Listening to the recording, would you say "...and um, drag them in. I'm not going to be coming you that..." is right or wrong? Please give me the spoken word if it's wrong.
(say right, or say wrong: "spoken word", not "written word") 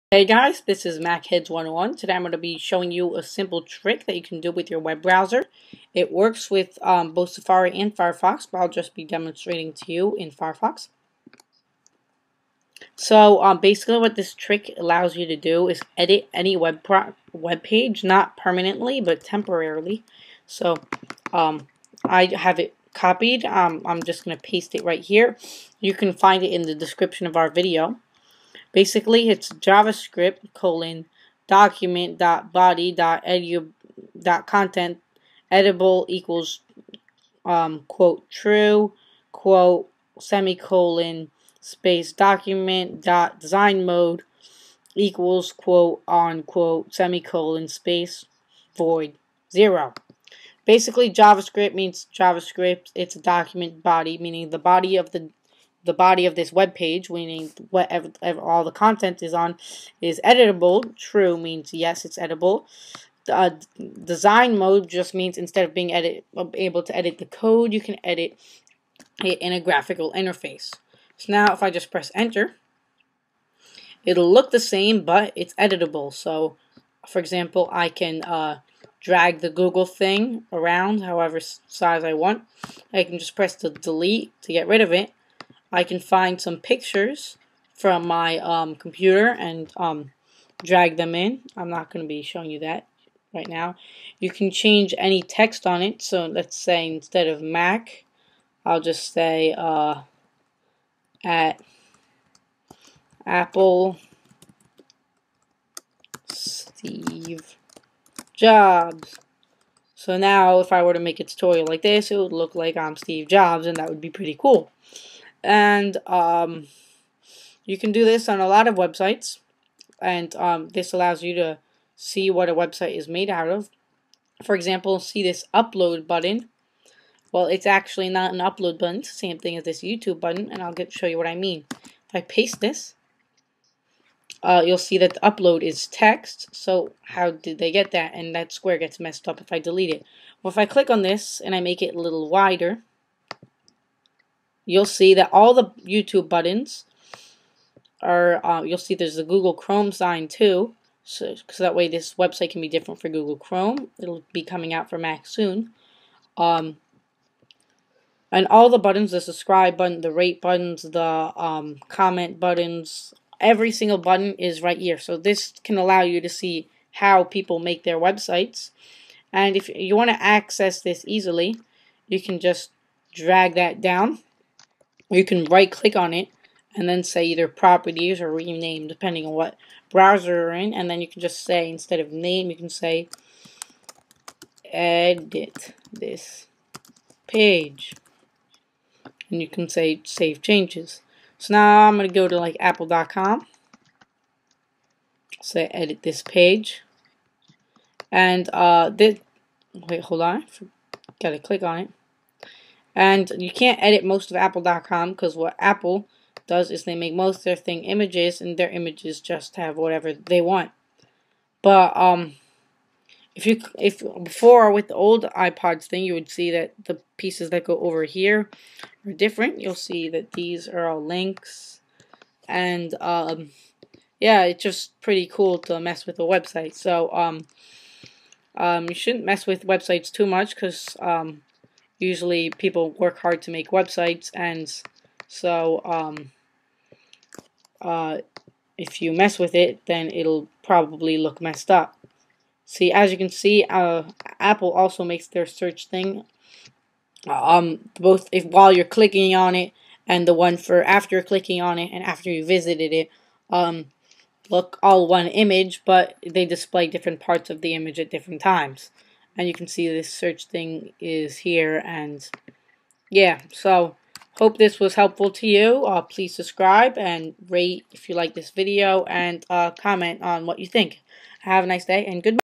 wrong: "showing", not "coming".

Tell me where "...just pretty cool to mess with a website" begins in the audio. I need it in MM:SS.
03:44.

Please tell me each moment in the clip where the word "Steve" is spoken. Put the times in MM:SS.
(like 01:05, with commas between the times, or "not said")
01:46, 01:52.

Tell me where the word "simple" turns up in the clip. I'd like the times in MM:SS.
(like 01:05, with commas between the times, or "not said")
00:03.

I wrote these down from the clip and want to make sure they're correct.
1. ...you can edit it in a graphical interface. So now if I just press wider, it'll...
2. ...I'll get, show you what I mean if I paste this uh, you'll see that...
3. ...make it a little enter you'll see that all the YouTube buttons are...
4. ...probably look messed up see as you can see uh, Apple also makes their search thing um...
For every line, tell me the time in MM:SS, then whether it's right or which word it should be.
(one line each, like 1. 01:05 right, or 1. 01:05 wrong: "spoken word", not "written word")
1. 01:07 wrong: "enter", not "wider"
2. 02:10 right
3. 02:21 wrong: "wider", not "enter"
4. 04:00 right.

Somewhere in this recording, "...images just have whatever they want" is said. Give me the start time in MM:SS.
03:28.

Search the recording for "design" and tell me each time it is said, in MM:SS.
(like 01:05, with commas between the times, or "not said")
00:43, 01:04.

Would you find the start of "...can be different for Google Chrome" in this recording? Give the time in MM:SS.
02:32.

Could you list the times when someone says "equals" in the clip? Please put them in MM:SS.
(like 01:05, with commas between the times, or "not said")
00:36, 00:44.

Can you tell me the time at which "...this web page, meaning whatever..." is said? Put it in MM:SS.
00:56.